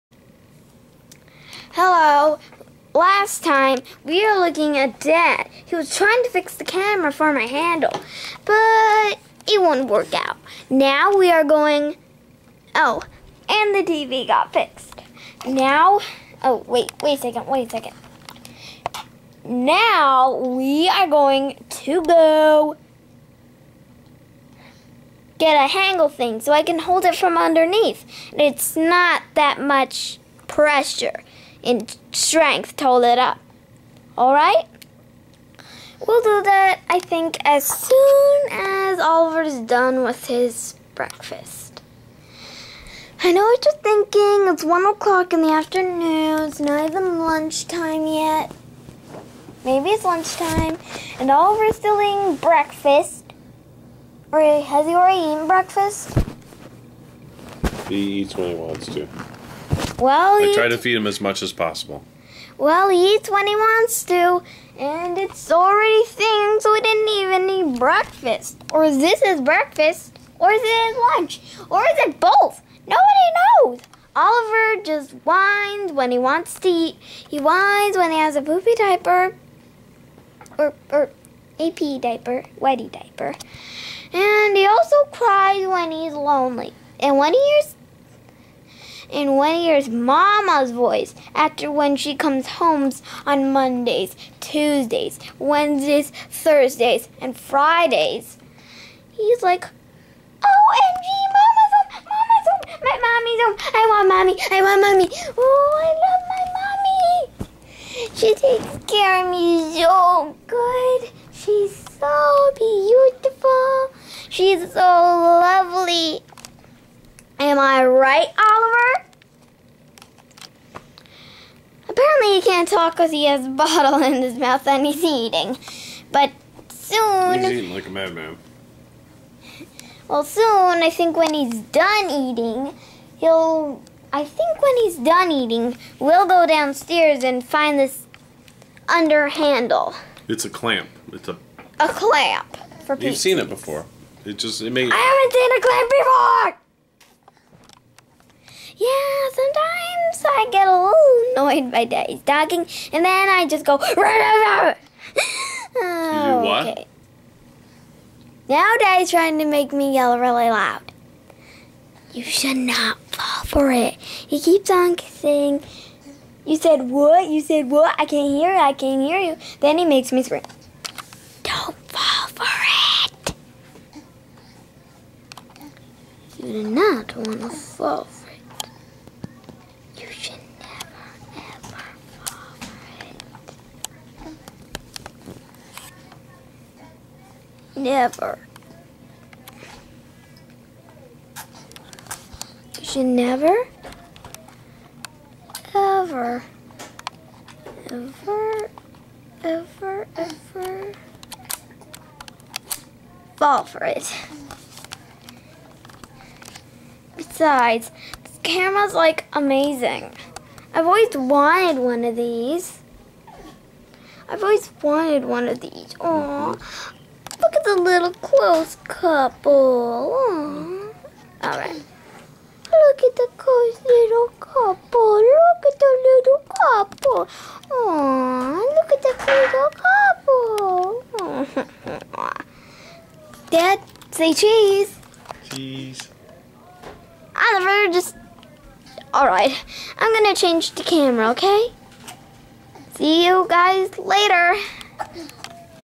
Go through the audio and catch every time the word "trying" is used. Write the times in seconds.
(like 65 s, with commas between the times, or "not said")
5 s, 159 s.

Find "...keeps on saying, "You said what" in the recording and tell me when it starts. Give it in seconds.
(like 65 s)
164 s.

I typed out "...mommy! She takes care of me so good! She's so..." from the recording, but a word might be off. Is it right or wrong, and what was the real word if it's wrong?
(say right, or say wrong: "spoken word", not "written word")
right.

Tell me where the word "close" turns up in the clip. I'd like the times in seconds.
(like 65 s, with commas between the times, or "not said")
218 s, 223 s.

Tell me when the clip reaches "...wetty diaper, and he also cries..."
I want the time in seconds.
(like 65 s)
82 s.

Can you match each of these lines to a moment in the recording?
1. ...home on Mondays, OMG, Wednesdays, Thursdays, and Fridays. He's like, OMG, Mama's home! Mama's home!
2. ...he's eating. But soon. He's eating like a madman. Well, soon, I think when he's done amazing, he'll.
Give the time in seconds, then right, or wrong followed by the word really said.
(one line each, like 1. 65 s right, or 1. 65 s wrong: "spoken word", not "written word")
1. 92 s wrong: "Tuesdays", not "OMG"
2. 124 s wrong: "eating", not "amazing".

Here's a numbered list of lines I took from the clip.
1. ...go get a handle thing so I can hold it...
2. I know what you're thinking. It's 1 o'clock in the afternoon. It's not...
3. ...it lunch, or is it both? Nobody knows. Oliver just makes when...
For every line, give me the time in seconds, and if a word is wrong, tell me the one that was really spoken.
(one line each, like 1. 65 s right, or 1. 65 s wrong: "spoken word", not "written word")
1. 22 s right
2. 43 s right
3. 70 s wrong: "whines", not "makes".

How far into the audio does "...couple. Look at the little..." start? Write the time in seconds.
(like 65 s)
224 s.